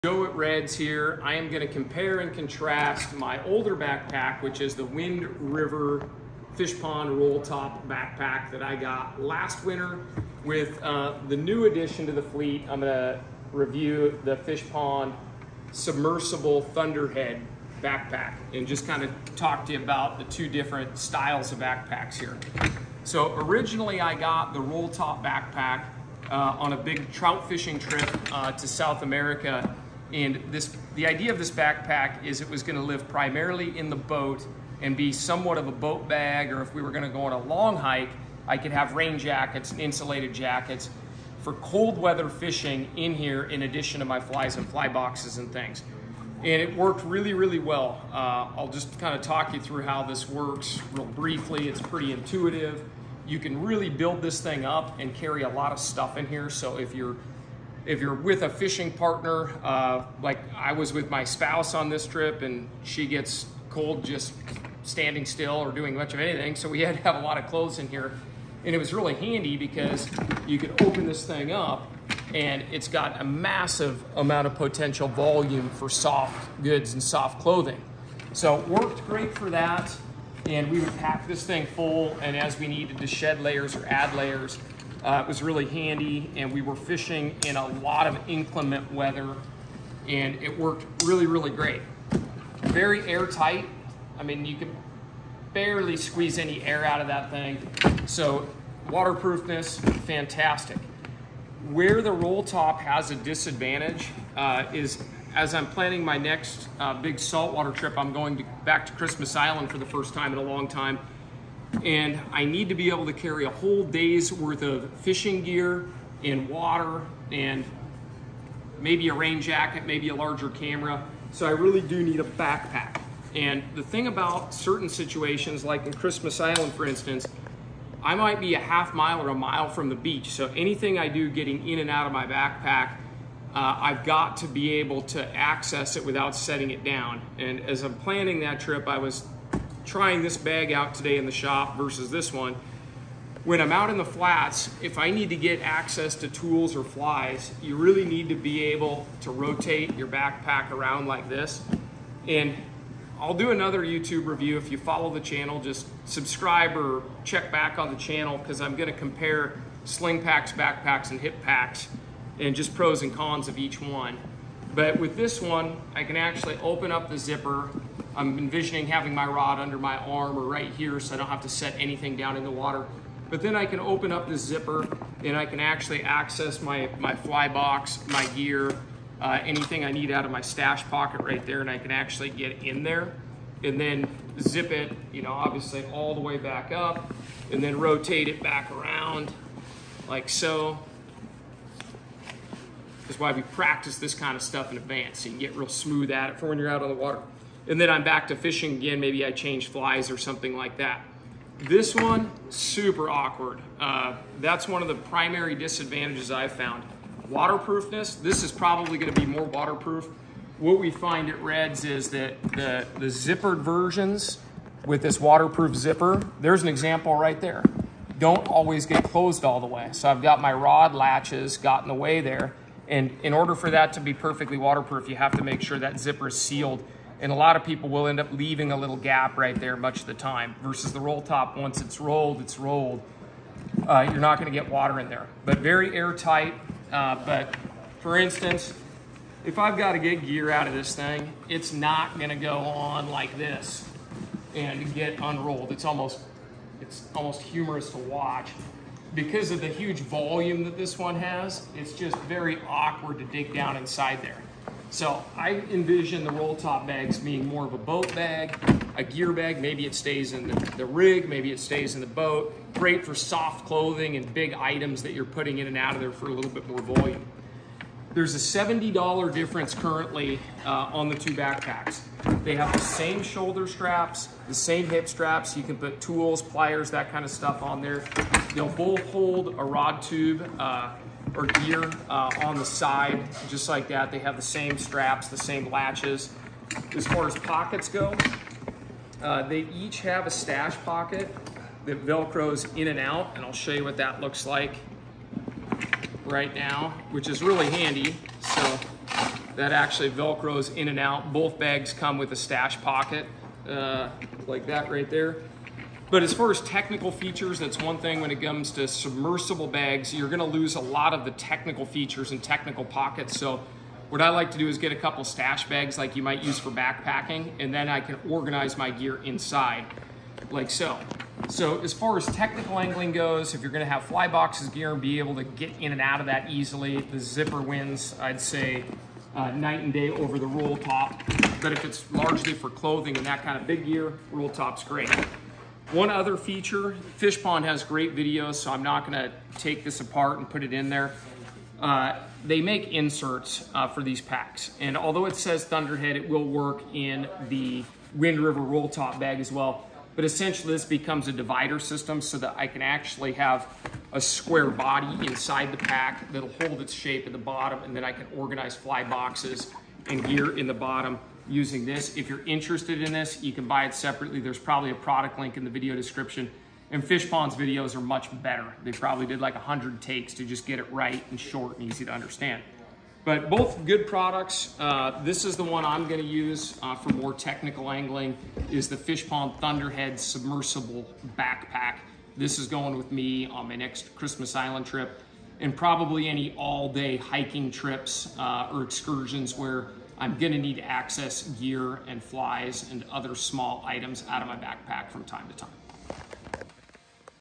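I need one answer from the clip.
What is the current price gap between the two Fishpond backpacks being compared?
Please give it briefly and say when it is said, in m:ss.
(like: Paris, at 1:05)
$70, at 4:28.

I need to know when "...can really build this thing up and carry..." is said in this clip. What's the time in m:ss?
0:53.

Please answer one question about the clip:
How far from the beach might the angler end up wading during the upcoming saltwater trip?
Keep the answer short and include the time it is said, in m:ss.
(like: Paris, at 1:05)
a mile, at 2:09.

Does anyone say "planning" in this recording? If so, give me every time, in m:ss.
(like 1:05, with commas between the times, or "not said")
1:45, 2:17.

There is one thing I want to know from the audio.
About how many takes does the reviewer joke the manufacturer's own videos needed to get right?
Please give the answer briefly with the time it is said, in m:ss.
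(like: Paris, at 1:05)
100, at 6:09.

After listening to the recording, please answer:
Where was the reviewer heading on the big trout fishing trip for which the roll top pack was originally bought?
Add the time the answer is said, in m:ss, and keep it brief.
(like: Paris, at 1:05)
South America, at 0:28.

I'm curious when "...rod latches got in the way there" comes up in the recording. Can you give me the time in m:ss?
3:40.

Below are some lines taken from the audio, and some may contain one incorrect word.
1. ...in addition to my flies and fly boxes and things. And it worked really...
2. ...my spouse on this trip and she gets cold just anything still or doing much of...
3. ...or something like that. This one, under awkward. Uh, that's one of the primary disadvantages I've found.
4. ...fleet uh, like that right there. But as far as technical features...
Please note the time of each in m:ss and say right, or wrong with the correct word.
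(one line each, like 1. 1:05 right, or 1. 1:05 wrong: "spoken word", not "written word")
1. 0:43 right
2. 1:01 wrong: "standing", not "anything"
3. 3:20 wrong: "super", not "under"
4. 5:02 wrong: "pocket", not "fleet".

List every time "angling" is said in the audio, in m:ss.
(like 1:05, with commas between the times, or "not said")
5:22, 6:17.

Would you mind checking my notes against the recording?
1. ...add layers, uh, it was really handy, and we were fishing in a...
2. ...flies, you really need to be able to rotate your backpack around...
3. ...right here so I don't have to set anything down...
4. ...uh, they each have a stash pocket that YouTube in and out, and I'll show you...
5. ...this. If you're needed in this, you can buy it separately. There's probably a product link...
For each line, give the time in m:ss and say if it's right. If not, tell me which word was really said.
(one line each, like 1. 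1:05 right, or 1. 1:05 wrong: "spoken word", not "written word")
1. 1:23 right
2. 2:26 right
3. 2:50 right
4. 4:49 wrong: "Velcros", not "YouTube"
5. 6:01 wrong: "interested", not "needed".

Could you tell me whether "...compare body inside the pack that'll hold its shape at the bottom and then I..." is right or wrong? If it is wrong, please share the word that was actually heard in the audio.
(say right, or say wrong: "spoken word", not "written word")
wrong: "square", not "compare".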